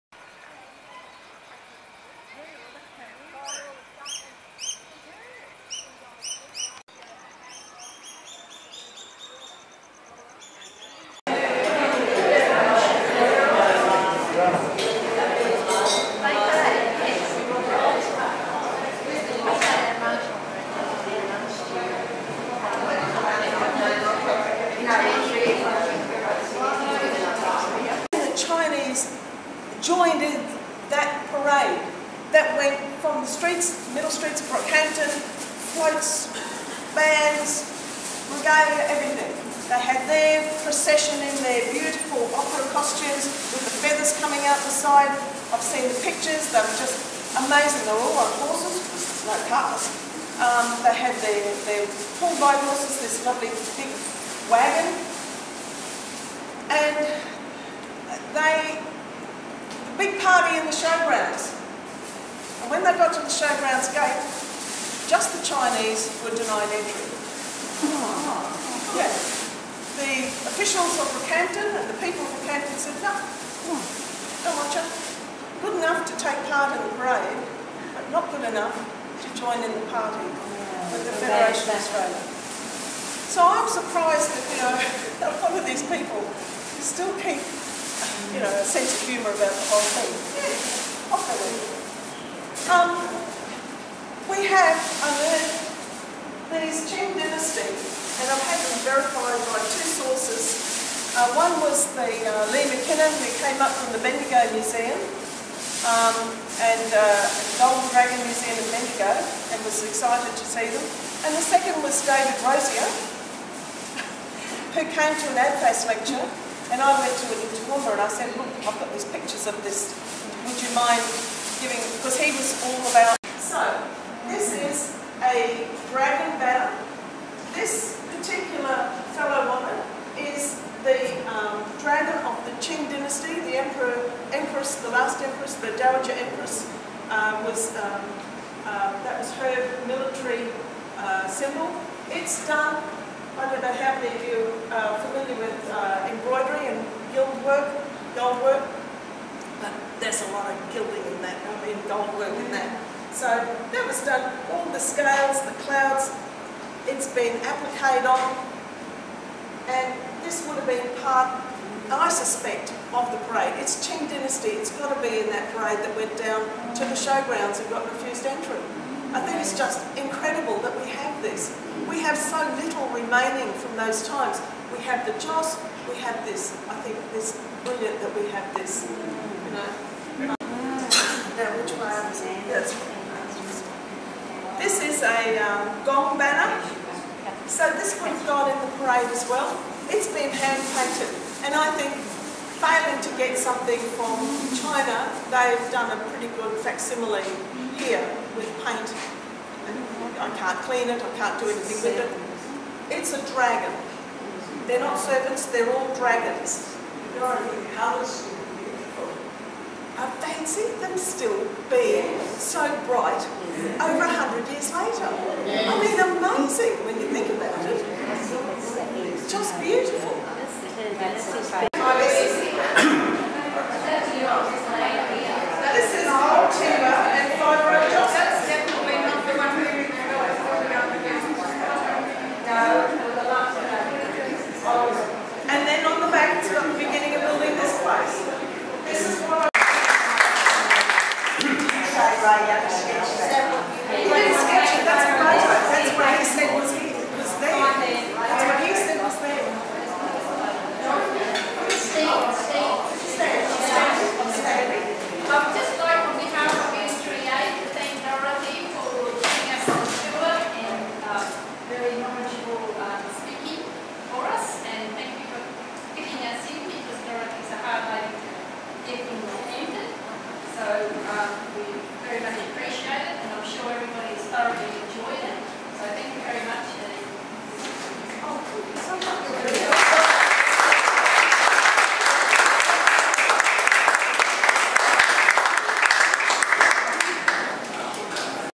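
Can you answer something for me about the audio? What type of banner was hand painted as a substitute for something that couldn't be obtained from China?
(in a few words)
Gong banner.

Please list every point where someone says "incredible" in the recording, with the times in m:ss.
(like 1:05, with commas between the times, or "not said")
2:49.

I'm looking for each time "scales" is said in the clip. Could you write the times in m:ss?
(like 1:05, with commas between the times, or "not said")
2:34.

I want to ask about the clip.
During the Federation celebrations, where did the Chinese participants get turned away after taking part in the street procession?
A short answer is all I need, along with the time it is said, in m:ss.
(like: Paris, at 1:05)
The showgrounds gate, at 1:03.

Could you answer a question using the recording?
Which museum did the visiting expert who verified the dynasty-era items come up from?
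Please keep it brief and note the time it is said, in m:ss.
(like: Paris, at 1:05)
Bendigo Museum, at 1:44.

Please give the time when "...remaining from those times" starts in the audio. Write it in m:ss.
2:52.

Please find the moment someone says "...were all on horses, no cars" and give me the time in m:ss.
0:47.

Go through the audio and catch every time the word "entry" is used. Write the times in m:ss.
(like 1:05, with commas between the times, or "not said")
1:06, 2:48.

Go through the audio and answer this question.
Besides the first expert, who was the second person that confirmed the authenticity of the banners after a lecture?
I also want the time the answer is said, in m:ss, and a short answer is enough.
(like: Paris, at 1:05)
David Rosier, at 1:52.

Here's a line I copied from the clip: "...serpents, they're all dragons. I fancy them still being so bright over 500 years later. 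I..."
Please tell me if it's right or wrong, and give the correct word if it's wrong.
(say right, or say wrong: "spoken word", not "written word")
wrong: "100", not "500".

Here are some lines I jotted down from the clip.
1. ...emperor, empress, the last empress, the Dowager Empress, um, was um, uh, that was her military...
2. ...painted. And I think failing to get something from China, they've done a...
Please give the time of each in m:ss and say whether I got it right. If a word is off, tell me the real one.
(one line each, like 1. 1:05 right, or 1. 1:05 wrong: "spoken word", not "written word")
1. 2:13 right
2. 3:10 right.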